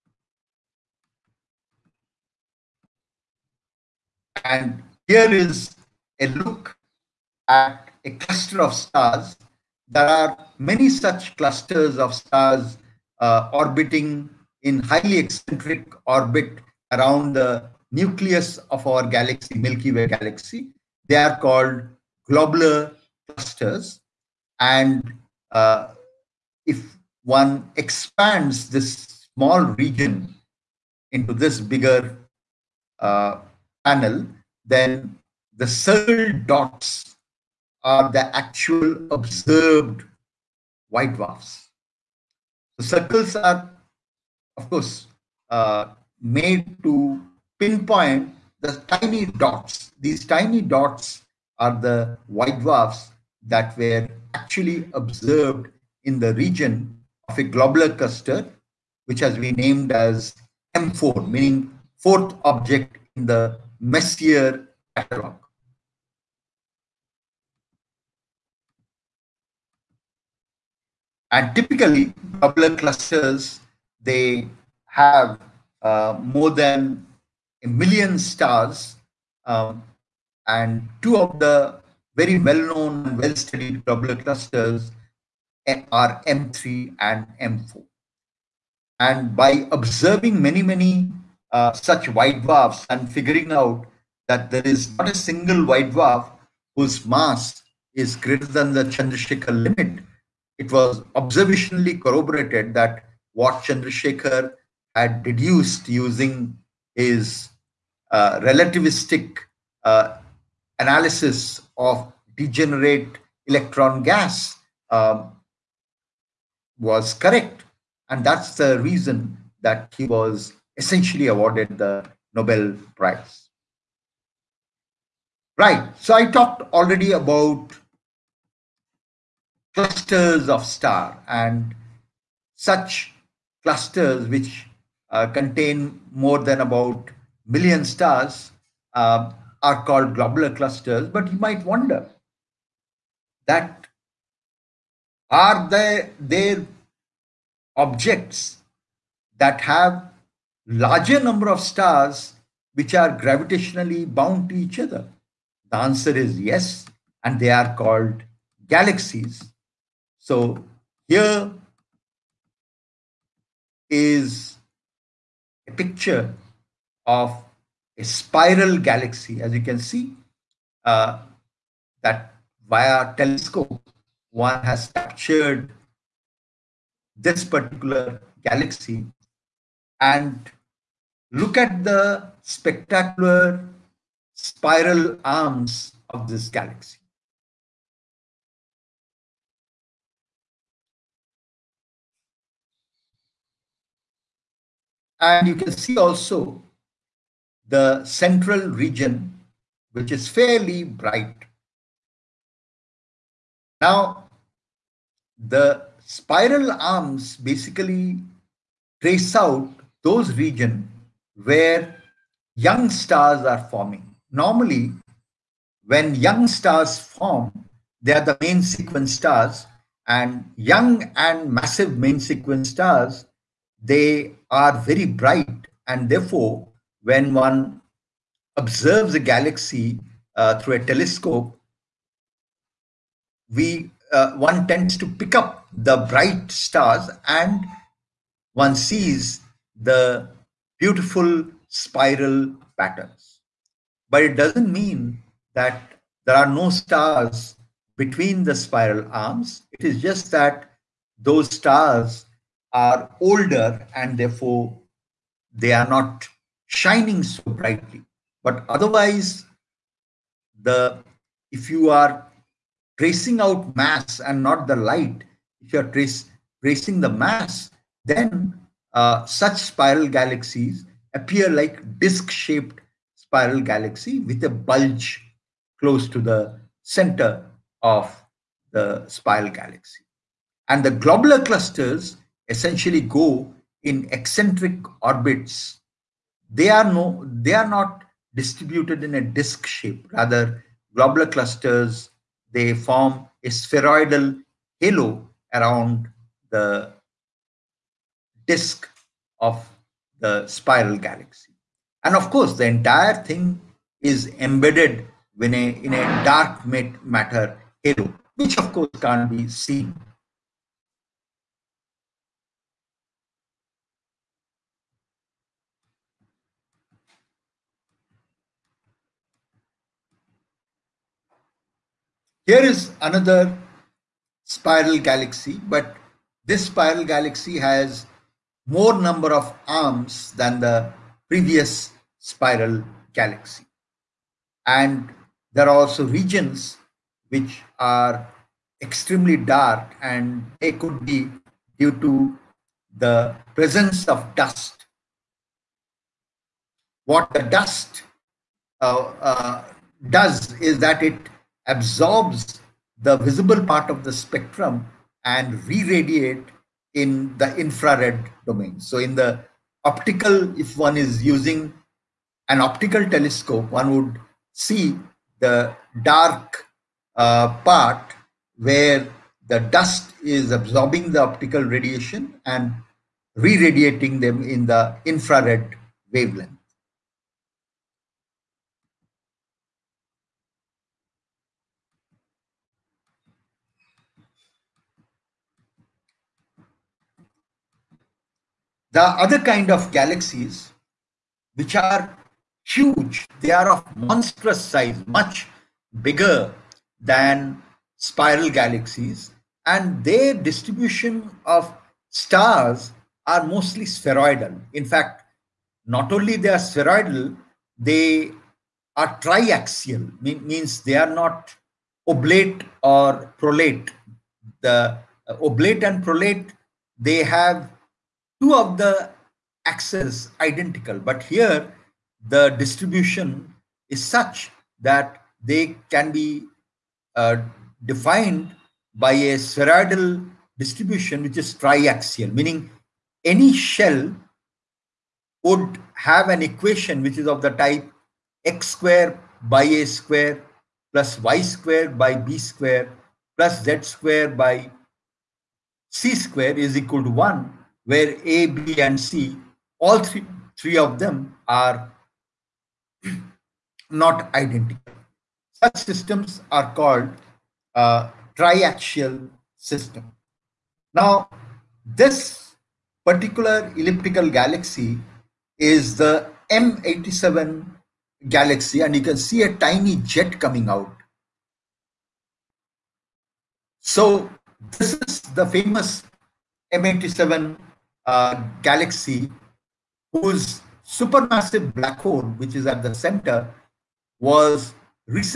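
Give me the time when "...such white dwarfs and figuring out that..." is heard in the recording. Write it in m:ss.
1:31.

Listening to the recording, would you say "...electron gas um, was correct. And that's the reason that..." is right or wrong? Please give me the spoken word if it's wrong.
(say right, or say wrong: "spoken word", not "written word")
right.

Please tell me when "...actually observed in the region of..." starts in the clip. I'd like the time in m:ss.
0:54.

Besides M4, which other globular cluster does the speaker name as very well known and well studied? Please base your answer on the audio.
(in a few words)
M3.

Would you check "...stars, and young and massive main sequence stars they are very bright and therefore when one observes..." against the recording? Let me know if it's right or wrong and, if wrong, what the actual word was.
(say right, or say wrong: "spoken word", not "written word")
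right.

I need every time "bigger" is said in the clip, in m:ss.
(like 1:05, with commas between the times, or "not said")
0:31, 6:36.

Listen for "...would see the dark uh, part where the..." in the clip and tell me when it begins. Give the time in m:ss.
6:03.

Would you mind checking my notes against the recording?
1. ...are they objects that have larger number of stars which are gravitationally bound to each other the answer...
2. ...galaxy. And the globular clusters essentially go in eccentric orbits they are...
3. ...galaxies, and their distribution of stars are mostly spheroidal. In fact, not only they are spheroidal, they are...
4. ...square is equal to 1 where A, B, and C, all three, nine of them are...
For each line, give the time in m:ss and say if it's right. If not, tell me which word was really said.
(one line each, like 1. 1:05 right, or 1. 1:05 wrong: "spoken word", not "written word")
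1. 2:25 right
2. 4:39 right
3. 6:38 right
4. 7:26 wrong: "three", not "nine".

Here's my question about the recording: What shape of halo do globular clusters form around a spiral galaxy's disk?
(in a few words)
spheroidal halo.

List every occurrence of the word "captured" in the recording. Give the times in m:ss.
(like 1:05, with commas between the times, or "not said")
2:54.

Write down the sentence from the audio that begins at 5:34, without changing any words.
And there are also regions which are extremely dark and they could be due to the presence of dust.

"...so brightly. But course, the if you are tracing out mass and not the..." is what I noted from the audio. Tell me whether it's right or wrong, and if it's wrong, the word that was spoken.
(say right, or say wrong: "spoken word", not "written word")
wrong: "otherwise", not "course".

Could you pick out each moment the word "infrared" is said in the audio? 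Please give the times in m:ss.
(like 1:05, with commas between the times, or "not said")
5:57, 6:15.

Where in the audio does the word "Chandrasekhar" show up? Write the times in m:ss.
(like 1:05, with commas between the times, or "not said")
1:38, 1:43.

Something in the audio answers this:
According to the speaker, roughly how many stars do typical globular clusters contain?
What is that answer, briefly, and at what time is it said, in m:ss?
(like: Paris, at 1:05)
more than a million, at 1:16.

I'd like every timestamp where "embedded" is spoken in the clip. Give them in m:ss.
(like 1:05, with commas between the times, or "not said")
5:04.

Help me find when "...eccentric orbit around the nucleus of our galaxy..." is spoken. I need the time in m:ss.
0:15.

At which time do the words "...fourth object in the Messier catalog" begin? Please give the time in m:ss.
1:01.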